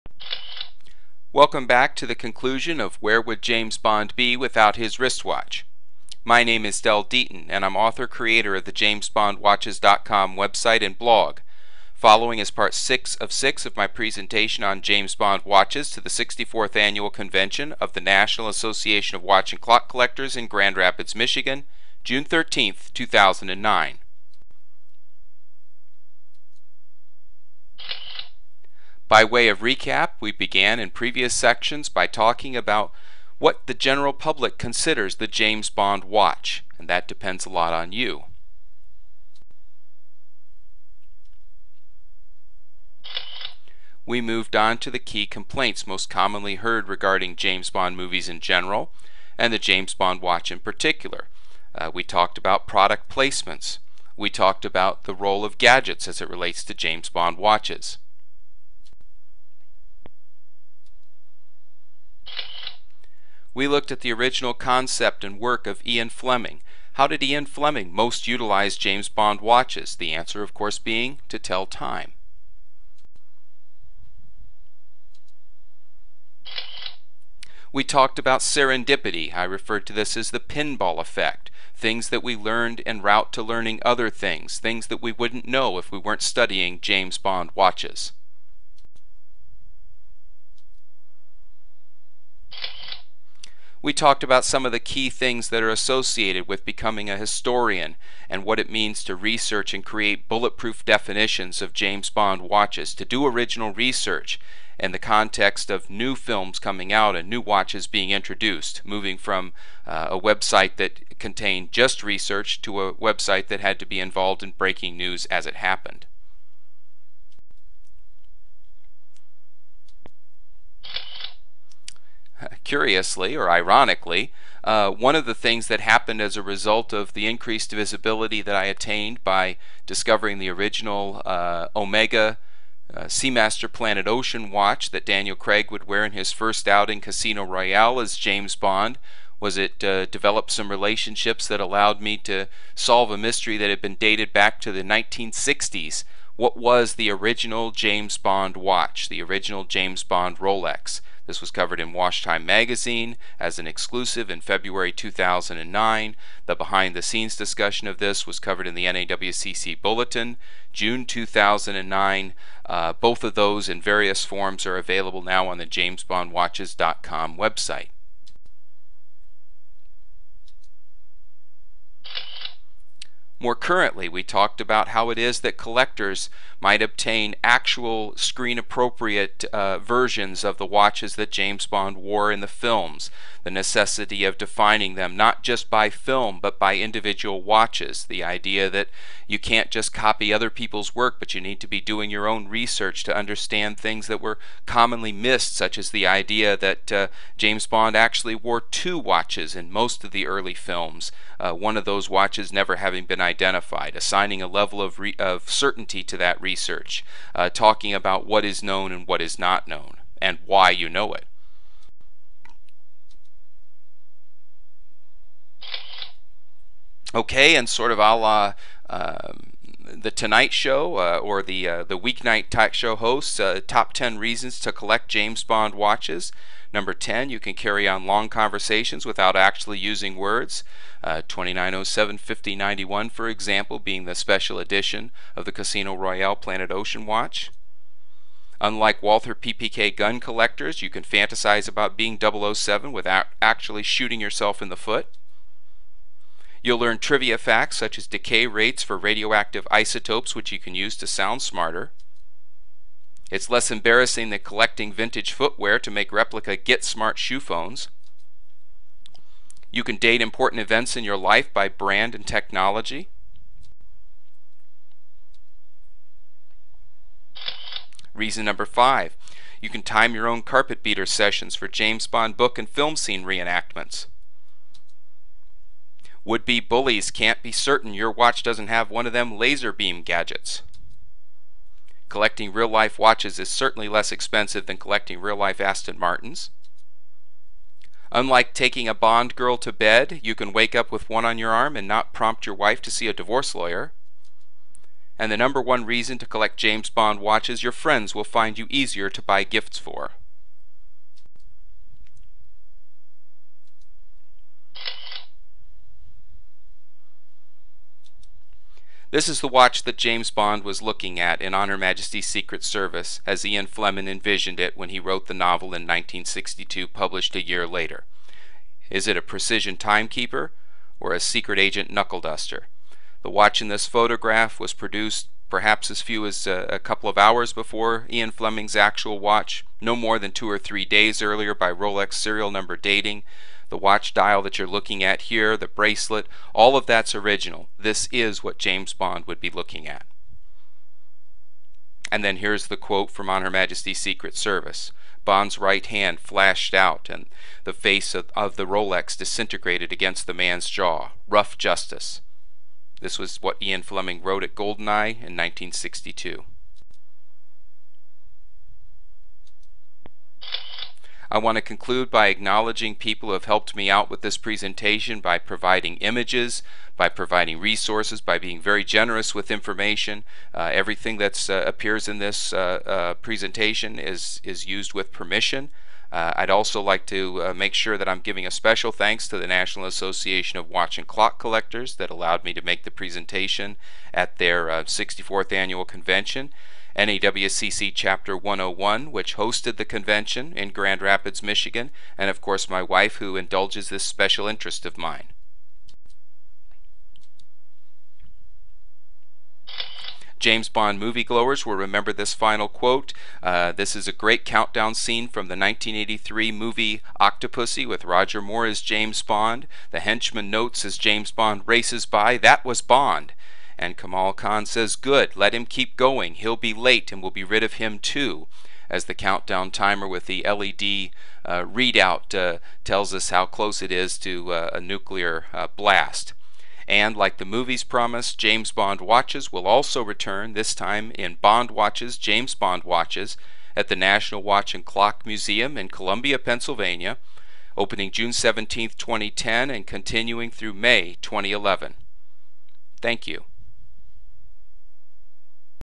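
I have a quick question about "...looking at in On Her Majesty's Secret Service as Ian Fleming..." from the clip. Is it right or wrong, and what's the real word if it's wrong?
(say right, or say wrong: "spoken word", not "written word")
right.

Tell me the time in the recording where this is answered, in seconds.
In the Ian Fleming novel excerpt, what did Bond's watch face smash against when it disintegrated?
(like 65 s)
350 s.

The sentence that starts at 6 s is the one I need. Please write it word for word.
My name is Dell Deaton, and I'm author creator of the JamesBondWatches.com website and blog.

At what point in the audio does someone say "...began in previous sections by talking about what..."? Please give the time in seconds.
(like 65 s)
30 s.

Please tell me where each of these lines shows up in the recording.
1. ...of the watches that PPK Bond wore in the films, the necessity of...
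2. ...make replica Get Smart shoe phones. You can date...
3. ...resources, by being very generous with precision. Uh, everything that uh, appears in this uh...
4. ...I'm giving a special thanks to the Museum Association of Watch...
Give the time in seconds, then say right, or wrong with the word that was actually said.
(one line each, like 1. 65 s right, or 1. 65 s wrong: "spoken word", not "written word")
1. 180 s wrong: "James", not "PPK"
2. 255 s right
3. 367 s wrong: "information", not "precision"
4. 378 s wrong: "National", not "Museum".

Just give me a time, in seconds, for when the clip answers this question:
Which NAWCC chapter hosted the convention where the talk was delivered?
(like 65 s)
387 s.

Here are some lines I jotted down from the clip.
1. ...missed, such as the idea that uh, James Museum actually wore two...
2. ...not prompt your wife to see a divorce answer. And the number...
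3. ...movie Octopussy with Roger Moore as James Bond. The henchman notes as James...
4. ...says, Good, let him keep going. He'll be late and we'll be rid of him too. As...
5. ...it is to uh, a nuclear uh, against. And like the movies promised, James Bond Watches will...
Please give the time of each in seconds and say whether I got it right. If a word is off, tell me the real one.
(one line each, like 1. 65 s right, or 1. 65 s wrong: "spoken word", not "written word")
1. 195 s wrong: "Bond", not "Museum"
2. 291 s wrong: "lawyer", not "answer"
3. 406 s right
4. 414 s right
5. 423 s wrong: "blast", not "against".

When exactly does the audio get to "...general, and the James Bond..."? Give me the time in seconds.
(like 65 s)
48 s.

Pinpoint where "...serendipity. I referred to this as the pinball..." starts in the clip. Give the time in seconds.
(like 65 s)
78 s.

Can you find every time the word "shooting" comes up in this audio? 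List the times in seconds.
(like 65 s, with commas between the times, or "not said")
243 s.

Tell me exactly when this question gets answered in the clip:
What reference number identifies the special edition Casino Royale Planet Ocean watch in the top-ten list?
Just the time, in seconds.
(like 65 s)
231 s.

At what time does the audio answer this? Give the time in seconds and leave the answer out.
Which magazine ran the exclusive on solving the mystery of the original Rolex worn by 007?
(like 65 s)
151 s.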